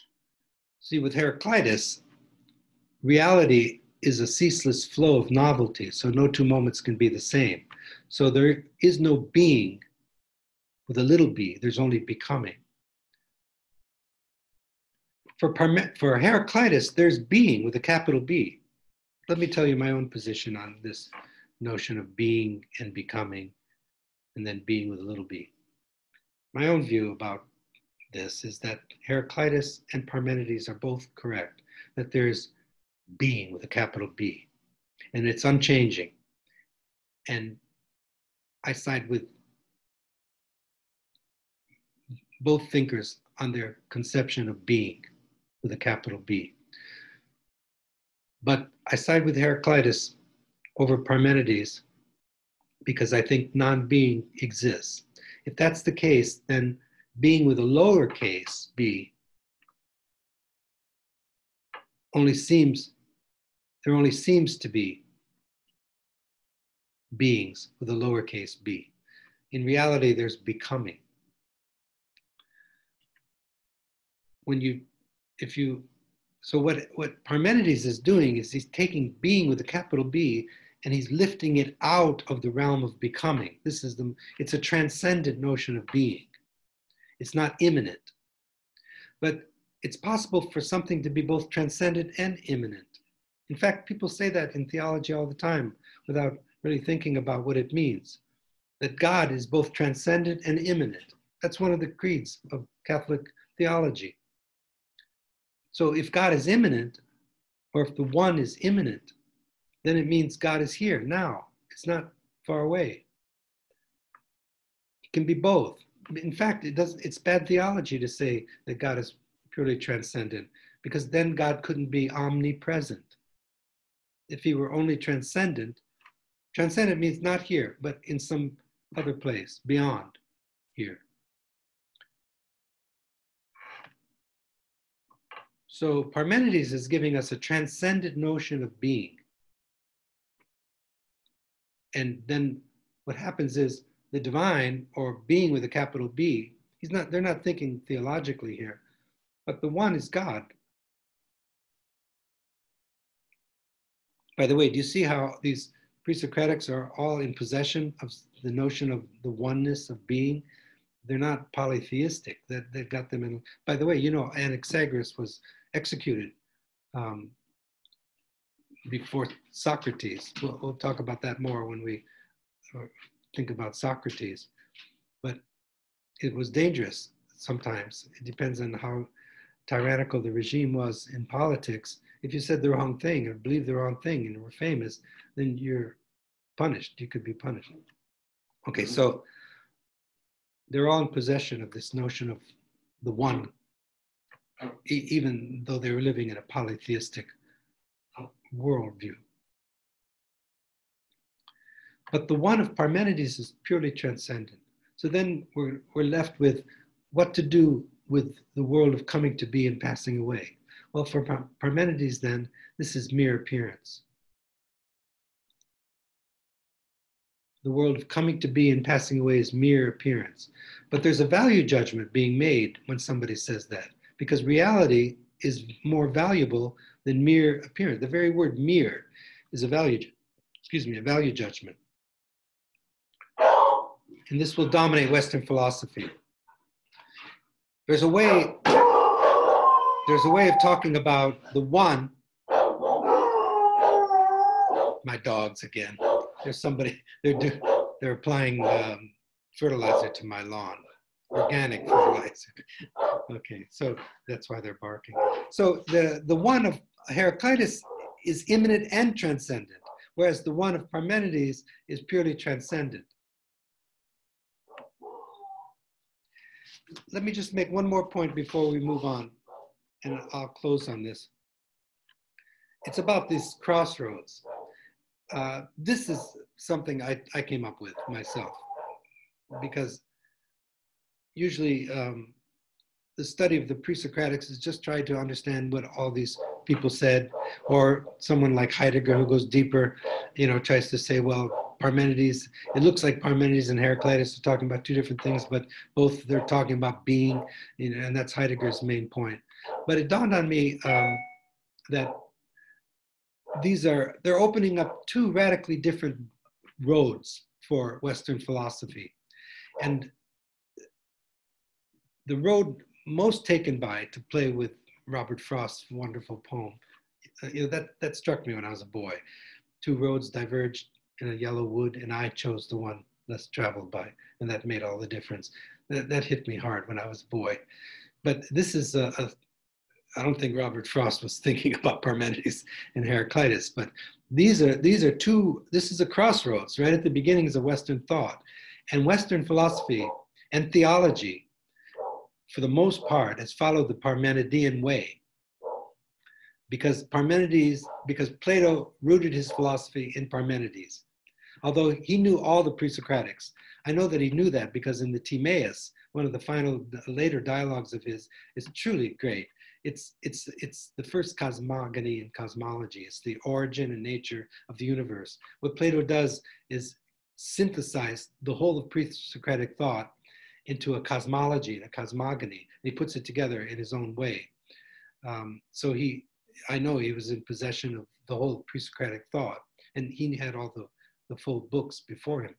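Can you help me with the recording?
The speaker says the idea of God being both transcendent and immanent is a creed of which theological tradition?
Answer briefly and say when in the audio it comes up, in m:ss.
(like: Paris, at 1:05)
Catholic theology, at 1:42.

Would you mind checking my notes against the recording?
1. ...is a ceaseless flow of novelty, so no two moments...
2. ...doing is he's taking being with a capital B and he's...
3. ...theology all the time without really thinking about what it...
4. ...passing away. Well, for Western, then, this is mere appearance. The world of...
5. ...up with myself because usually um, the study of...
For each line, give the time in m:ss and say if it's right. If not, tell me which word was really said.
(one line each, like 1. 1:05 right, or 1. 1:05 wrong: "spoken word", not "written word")
1. 0:04 right
2. 1:17 right
3. 1:34 right
4. 3:29 wrong: "Parmenides", not "Western"
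5. 4:37 right.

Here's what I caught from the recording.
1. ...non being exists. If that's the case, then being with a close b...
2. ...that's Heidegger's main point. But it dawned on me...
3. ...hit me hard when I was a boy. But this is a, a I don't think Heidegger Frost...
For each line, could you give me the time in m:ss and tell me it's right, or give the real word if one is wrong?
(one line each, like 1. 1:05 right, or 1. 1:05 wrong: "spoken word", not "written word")
1. 0:53 wrong: "lowercase", not "close"
2. 4:58 right
3. 5:26 wrong: "Robert", not "Heidegger".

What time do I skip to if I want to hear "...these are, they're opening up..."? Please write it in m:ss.
5:03.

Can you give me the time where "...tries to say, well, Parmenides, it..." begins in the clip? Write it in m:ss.
4:50.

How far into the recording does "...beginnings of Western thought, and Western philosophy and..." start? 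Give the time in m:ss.
5:37.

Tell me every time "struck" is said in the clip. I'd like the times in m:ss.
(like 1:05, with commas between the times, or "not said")
5:18.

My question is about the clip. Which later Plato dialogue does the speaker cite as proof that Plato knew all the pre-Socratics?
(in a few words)
Timaeus.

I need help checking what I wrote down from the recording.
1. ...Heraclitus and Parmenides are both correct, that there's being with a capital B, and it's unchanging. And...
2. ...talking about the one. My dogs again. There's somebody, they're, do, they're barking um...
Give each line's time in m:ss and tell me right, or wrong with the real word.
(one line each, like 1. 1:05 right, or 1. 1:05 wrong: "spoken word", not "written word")
1. 0:29 right
2. 4:00 wrong: "applying", not "barking".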